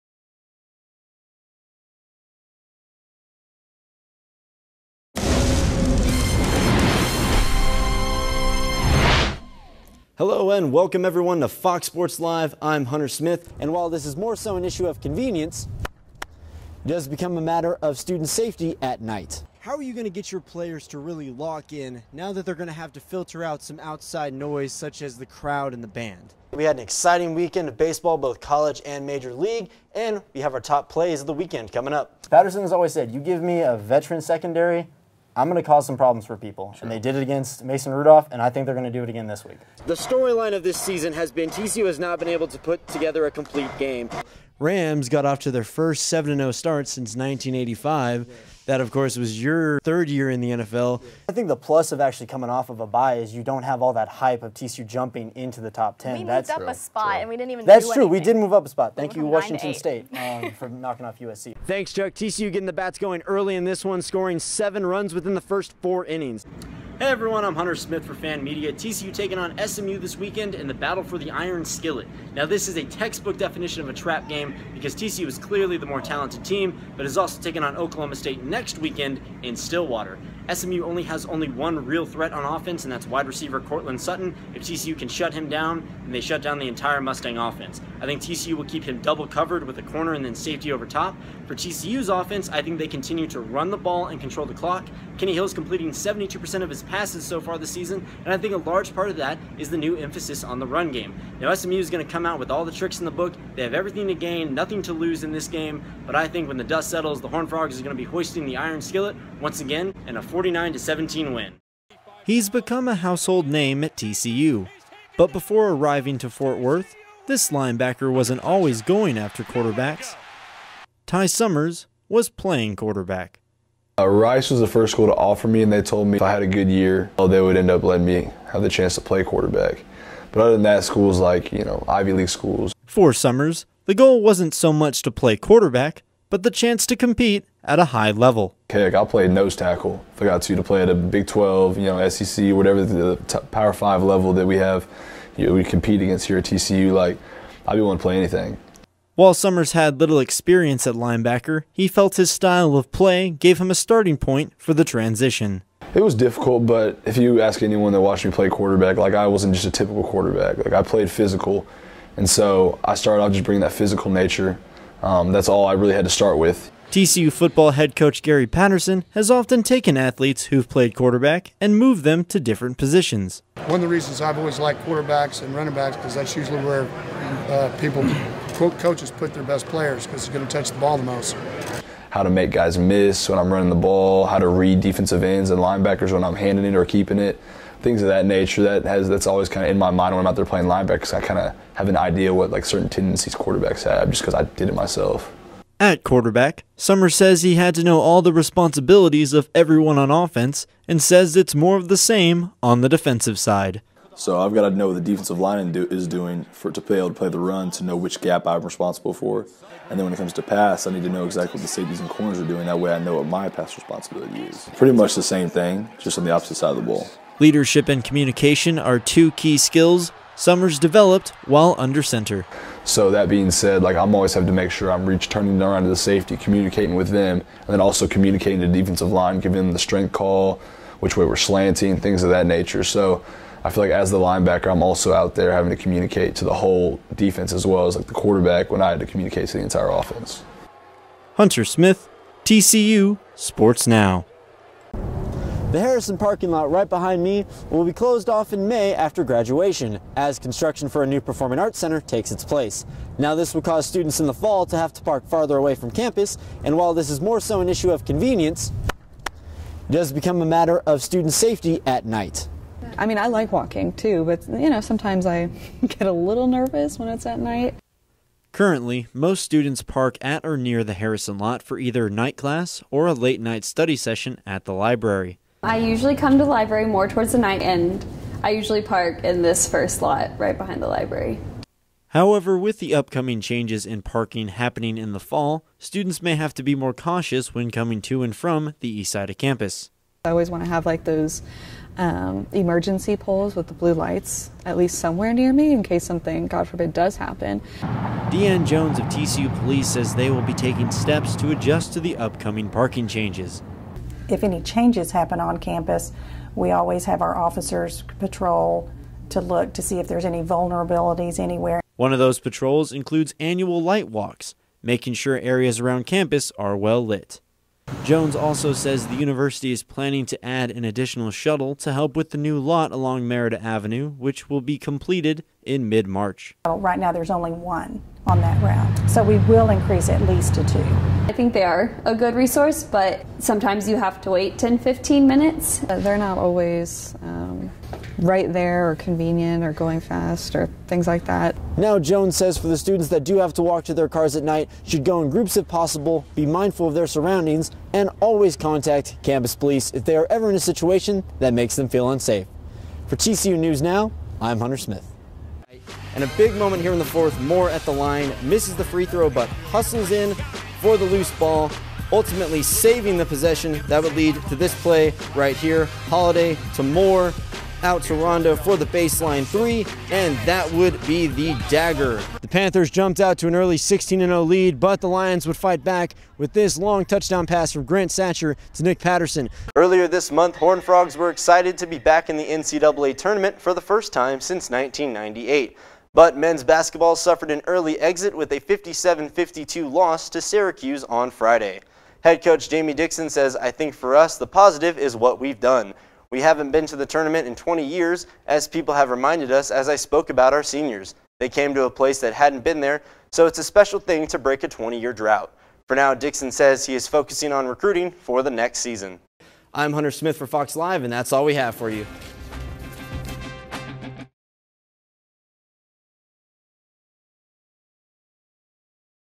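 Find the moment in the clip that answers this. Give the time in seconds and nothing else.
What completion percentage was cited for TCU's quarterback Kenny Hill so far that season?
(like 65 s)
95 s.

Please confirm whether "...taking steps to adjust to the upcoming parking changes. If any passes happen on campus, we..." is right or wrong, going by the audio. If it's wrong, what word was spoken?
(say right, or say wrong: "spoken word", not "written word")
wrong: "changes", not "passes".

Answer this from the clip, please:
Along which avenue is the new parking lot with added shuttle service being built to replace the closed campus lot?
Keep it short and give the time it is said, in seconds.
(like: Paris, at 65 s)
Merida Avenue, at 323 s.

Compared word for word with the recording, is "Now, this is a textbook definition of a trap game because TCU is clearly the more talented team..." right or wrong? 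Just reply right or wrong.
right.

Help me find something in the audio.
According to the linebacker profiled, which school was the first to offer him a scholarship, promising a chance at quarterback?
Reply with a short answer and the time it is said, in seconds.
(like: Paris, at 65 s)
Rice, at 124 s.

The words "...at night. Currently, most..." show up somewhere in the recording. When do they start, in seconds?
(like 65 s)
267 s.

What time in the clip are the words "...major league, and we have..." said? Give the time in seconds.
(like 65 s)
29 s.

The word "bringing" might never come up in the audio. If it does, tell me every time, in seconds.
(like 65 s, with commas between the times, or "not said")
163 s.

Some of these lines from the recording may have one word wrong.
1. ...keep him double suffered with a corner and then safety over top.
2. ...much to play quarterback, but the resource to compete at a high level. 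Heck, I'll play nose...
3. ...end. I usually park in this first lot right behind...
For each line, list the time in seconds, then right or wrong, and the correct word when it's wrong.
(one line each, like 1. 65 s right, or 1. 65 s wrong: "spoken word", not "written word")
1. 88 s wrong: "covered", not "suffered"
2. 134 s wrong: "chance", not "resource"
3. 277 s right.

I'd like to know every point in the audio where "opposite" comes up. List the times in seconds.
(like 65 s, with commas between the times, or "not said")
216 s.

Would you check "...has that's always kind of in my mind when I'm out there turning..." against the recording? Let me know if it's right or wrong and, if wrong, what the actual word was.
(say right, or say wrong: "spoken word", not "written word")
wrong: "playing", not "turning".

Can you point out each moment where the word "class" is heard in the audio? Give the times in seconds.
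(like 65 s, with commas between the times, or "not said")
272 s.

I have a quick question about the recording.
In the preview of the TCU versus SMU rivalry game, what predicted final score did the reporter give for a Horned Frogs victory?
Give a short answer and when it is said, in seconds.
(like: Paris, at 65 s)
49-17, at 110 s.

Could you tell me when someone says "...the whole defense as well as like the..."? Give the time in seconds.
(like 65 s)
236 s.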